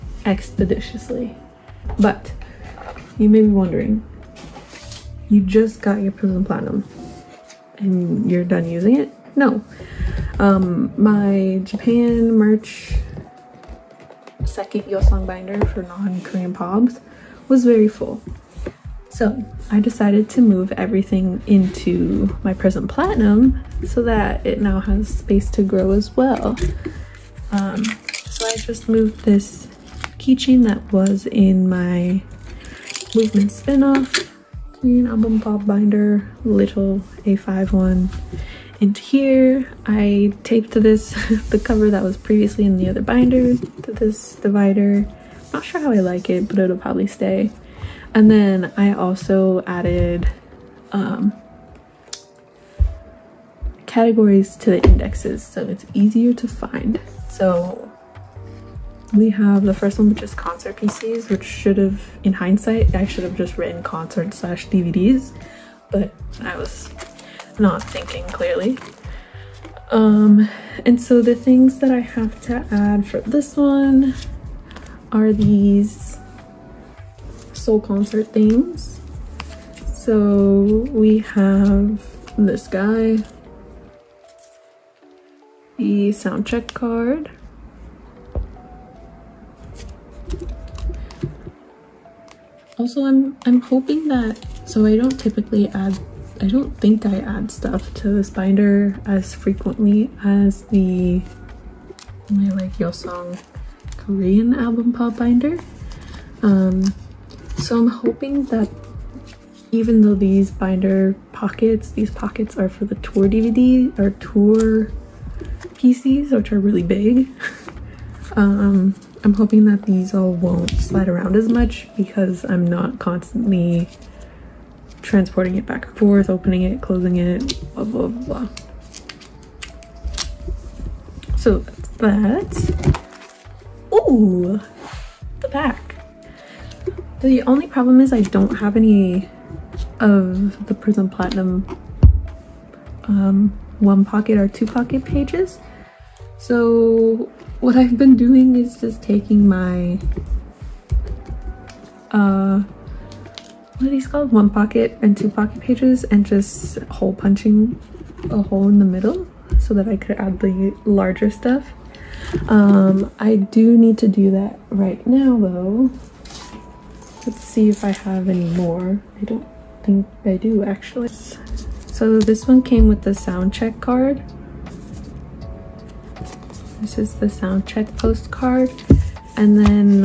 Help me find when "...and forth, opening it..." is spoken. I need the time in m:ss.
2:05.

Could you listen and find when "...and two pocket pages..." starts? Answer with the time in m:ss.
2:35.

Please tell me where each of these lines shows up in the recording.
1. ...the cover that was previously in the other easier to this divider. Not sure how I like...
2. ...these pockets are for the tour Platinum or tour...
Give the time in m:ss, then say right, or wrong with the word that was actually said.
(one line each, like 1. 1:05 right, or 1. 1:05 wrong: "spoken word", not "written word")
1. 0:41 wrong: "binder", not "easier"
2. 1:51 wrong: "DVD", not "Platinum".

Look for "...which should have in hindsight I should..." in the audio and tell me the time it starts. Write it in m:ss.
1:01.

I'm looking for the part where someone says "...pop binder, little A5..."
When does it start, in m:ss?
0:35.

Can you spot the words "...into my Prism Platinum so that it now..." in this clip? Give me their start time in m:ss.
0:21.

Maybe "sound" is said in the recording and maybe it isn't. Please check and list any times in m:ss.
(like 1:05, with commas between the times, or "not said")
1:26, 2:53, 2:57.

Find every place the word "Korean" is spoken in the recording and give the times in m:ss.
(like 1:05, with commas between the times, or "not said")
0:15, 0:34, 1:43.